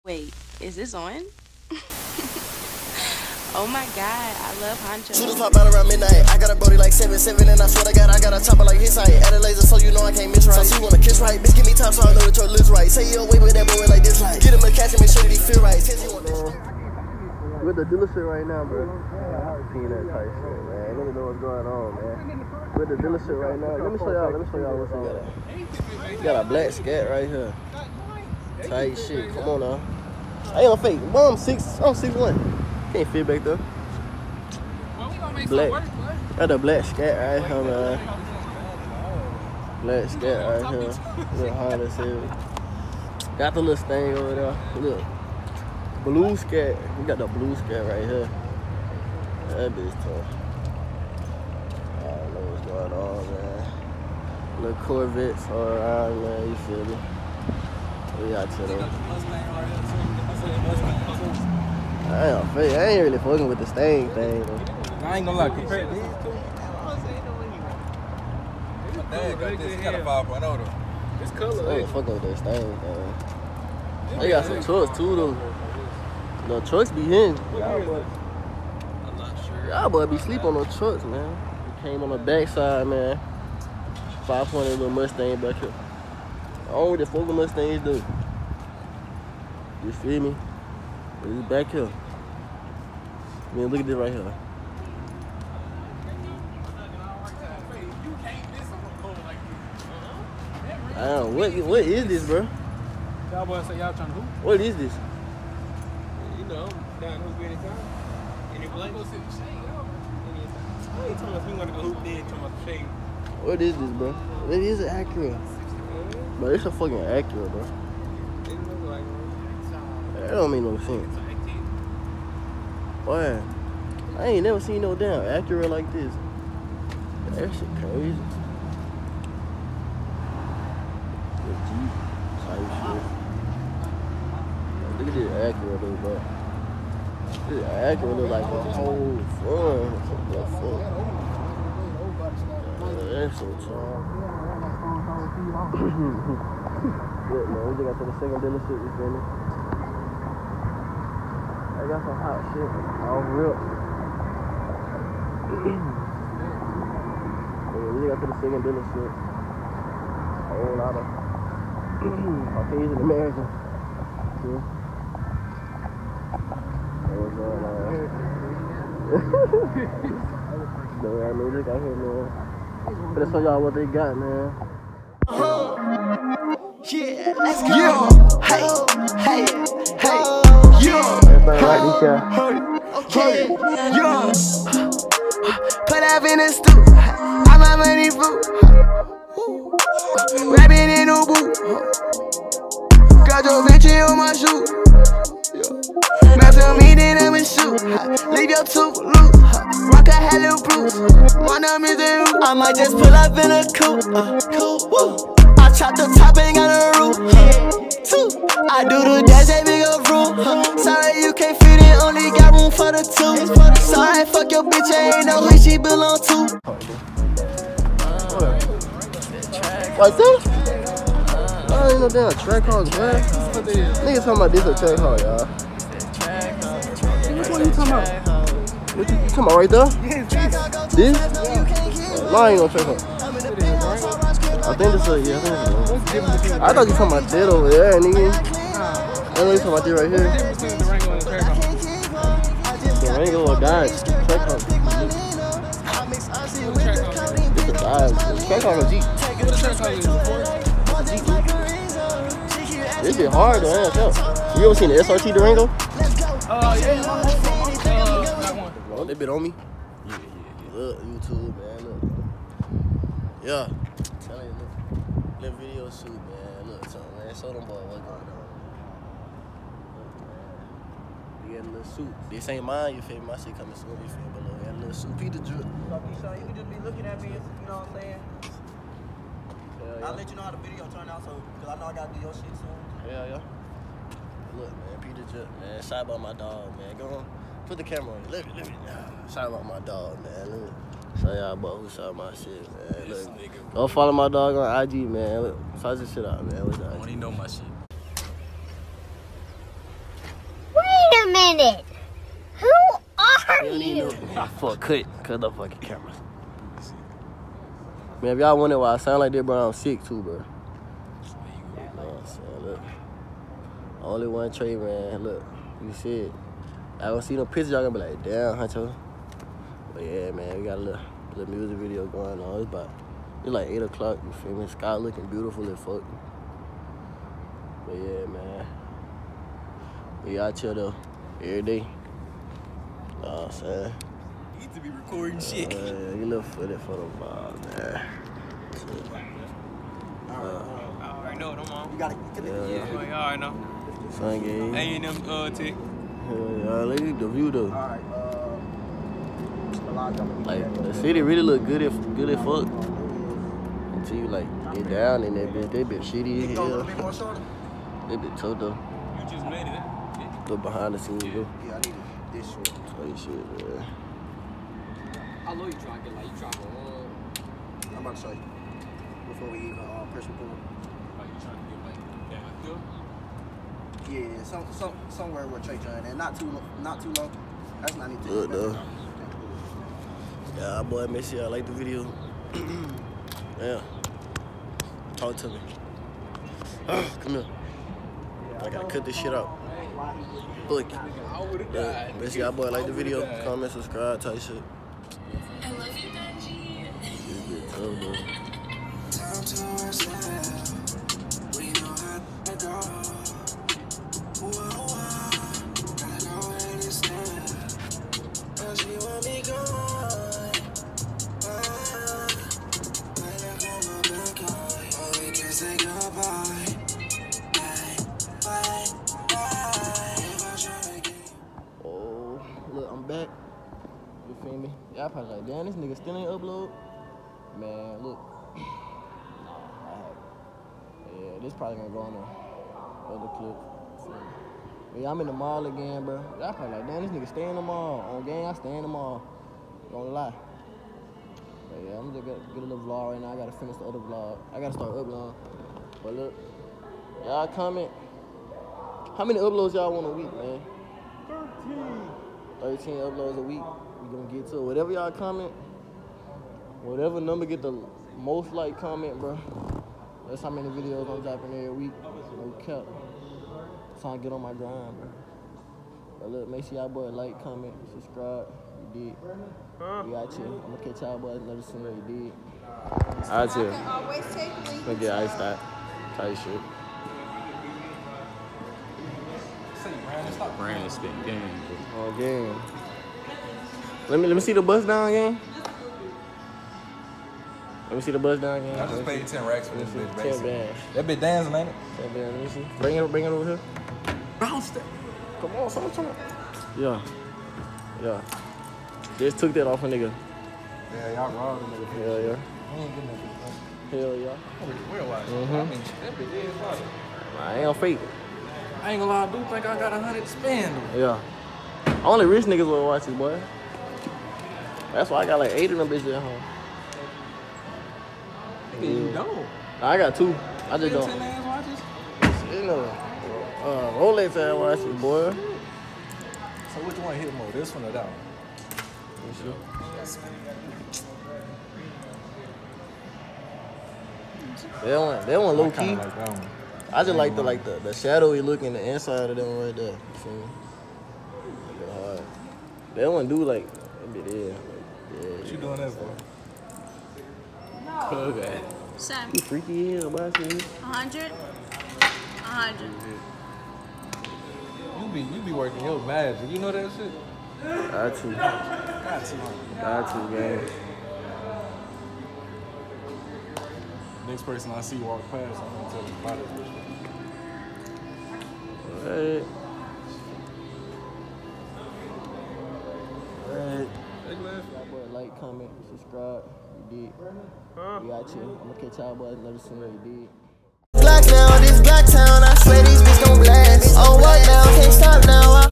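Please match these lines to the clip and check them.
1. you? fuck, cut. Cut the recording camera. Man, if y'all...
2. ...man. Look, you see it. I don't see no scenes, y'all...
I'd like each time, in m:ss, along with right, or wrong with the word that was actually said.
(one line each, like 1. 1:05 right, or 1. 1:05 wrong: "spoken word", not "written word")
1. 5:04 wrong: "fucking", not "recording"
2. 5:14 wrong: "pictures", not "scenes".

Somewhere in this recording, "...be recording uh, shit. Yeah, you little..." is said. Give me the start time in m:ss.
5:34.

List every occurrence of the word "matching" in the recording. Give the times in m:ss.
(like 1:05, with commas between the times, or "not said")
not said.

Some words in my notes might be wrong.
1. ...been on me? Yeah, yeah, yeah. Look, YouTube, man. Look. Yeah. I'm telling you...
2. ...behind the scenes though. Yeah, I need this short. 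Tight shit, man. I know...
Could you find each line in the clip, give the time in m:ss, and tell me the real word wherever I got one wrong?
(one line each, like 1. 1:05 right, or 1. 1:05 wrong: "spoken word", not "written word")
1. 4:19 right
2. 6:00 right.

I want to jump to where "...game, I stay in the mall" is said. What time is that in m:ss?
7:18.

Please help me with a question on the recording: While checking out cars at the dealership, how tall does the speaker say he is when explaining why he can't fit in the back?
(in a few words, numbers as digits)
6'1.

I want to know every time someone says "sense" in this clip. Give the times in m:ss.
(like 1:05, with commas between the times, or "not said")
2:00.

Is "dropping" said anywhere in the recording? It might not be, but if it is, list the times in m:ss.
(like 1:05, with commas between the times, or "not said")
7:41.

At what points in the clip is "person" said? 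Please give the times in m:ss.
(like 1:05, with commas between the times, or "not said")
9:24.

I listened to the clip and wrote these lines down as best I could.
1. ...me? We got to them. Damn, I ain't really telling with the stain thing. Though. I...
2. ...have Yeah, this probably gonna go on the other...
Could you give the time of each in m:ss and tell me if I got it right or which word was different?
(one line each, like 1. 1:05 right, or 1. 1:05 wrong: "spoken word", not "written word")
1. 0:56 wrong: "fucking", not "telling"
2. 7:09 right.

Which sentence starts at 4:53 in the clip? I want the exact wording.
This Look, nigga, go follow my dog on IG, man.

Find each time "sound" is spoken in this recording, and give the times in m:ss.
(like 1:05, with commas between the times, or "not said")
5:08.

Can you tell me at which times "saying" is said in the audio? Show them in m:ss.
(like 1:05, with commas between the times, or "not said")
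4:38, 5:12, 5:33.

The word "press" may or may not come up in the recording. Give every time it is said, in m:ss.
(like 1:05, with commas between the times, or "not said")
6:10.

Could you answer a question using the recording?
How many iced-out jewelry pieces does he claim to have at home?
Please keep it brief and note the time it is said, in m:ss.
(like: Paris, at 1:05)
8, at 8:35.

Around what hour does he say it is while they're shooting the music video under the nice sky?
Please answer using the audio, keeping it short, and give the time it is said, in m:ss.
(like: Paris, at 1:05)
8 o'clock, at 5:23.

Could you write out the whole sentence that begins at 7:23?
I gotta finish the other vlog.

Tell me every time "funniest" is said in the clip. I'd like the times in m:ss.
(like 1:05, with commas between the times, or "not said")
not said.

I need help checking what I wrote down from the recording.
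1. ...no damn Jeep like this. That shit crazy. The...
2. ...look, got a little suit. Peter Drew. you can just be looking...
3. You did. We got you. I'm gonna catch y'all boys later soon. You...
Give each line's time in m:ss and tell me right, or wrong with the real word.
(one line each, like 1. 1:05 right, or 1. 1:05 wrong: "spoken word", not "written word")
1. 2:04 wrong: "Acura", not "Jeep"
2. 4:34 right
3. 7:48 right.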